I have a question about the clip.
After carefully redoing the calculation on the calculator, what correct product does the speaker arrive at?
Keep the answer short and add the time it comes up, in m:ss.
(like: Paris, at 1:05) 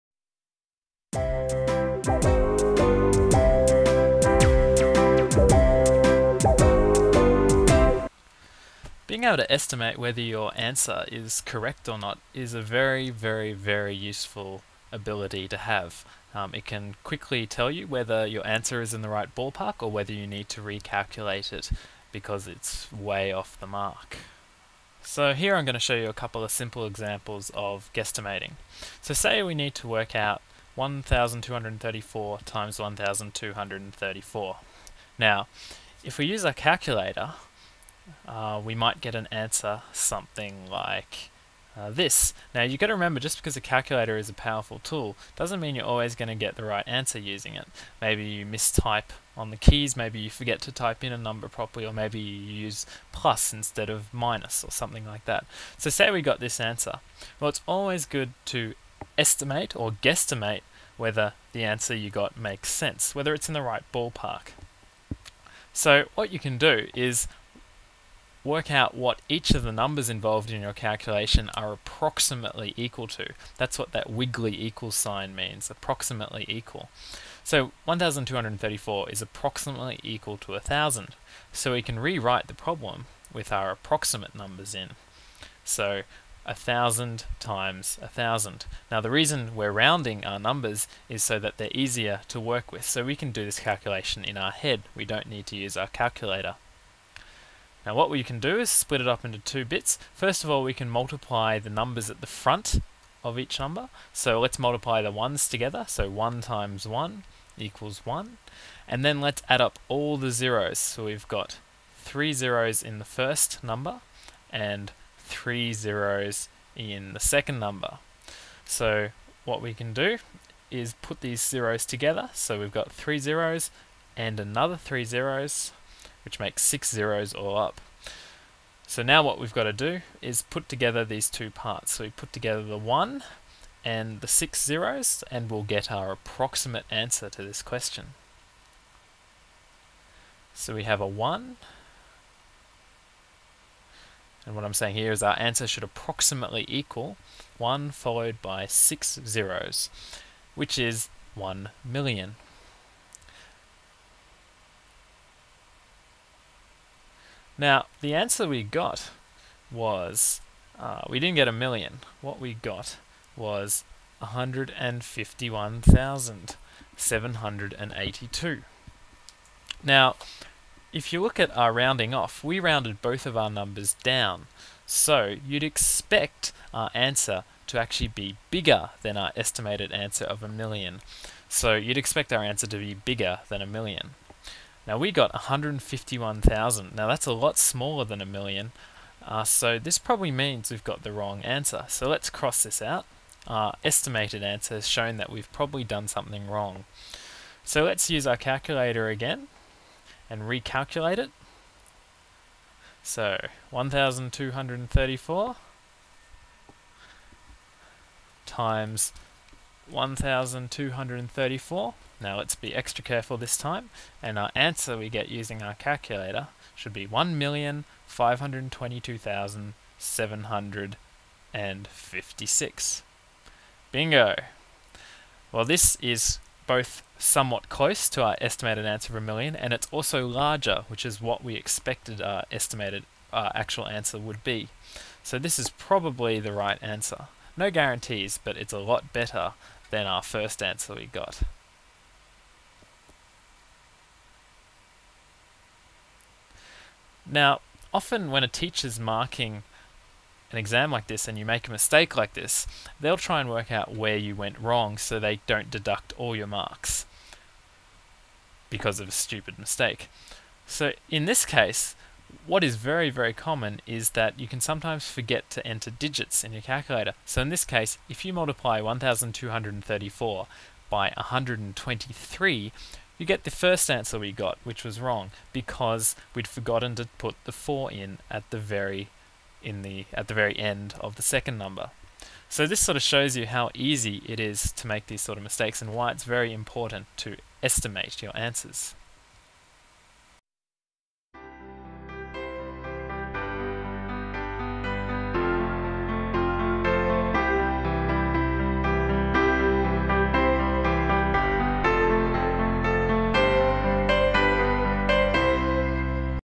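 1,522,756, at 3:37.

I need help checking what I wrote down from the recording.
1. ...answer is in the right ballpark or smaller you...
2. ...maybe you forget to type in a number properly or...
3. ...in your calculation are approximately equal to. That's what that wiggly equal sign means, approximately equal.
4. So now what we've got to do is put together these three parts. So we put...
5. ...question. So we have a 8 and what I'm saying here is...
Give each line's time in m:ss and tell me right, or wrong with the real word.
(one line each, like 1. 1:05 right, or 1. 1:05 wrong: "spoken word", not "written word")
1. 0:18 wrong: "whether", not "smaller"
2. 0:49 right
3. 1:10 right
4. 2:08 wrong: "two", not "three"
5. 2:17 wrong: "1", not "8".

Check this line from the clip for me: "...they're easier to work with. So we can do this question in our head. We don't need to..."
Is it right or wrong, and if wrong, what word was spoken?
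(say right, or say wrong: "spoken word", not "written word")
wrong: "calculation", not "question".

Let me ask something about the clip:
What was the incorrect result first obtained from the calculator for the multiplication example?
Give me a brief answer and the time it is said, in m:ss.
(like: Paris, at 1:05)
151,782, at 2:44.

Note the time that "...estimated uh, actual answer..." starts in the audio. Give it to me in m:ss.
3:52.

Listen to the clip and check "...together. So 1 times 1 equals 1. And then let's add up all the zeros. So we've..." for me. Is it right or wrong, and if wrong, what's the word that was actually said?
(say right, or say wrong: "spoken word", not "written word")
right.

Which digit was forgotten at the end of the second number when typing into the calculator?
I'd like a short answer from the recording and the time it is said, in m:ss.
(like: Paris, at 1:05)
4, at 4:37.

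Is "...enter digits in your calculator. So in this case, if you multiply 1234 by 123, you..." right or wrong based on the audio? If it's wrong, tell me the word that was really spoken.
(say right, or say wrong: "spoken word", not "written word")
right.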